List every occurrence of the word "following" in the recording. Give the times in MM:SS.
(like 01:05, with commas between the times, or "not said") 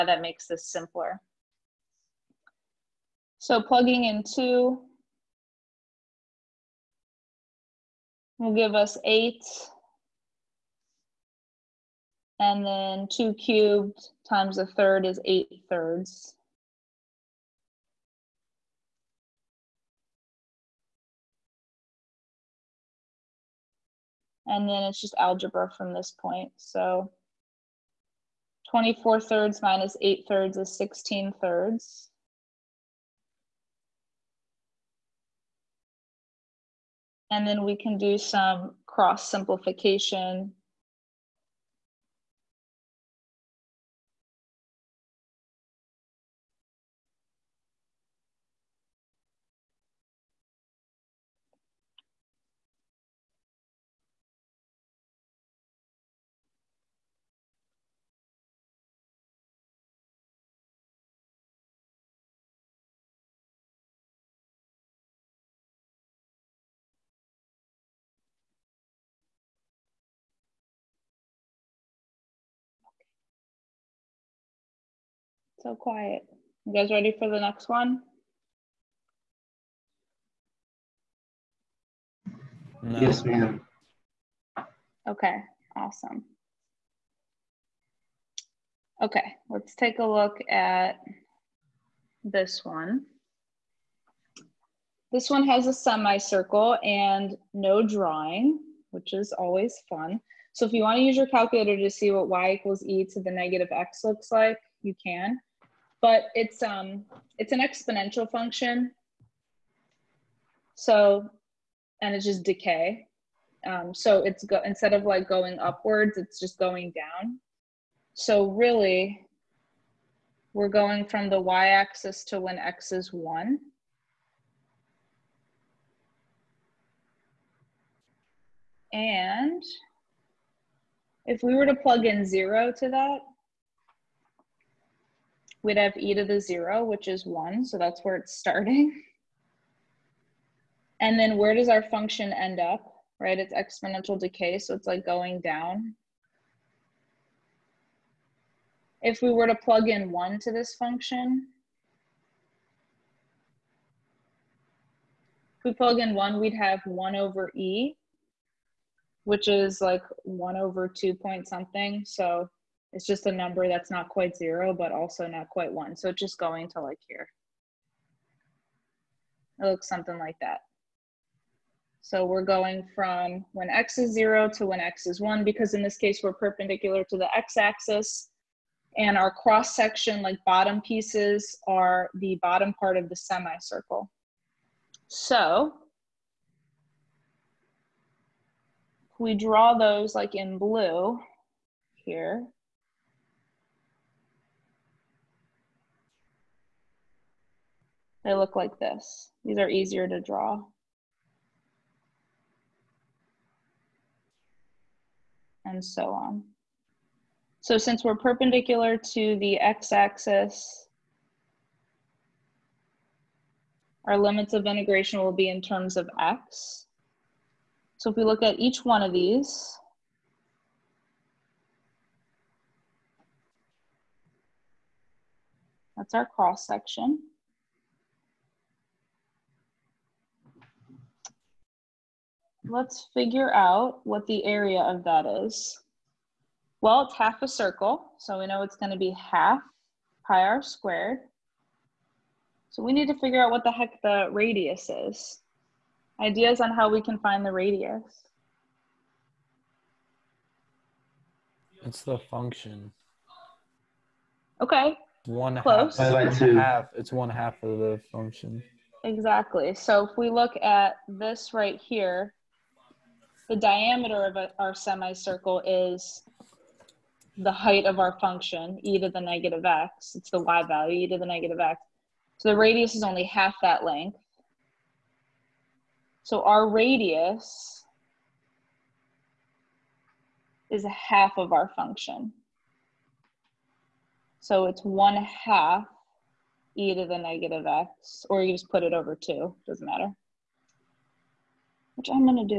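not said.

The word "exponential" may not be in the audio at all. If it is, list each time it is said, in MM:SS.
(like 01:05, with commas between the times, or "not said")
01:47, 02:23.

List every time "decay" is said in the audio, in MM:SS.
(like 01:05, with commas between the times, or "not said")
01:52, 02:24.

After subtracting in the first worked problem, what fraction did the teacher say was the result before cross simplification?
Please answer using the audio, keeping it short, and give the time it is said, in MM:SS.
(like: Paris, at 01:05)
16/3, at 00:30.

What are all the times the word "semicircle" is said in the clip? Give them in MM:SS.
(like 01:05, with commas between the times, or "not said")
01:35, 03:03, 04:24.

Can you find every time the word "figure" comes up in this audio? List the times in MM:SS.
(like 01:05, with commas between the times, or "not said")
03:53, 04:03.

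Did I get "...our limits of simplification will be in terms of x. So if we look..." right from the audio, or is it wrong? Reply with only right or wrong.
wrong.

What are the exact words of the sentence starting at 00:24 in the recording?
and then it's just algebra from this point.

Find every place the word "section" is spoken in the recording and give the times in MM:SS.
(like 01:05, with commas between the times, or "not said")
02:59, 03:46.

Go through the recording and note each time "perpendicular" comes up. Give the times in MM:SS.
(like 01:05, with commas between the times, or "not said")
02:56, 03:28.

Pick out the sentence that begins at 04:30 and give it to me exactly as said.
It's the y value, e to the negative x.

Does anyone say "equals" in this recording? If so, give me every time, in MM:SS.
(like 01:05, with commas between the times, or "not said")
01:42.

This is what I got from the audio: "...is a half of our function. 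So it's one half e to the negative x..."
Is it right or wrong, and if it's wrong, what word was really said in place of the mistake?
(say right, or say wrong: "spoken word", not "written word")
right.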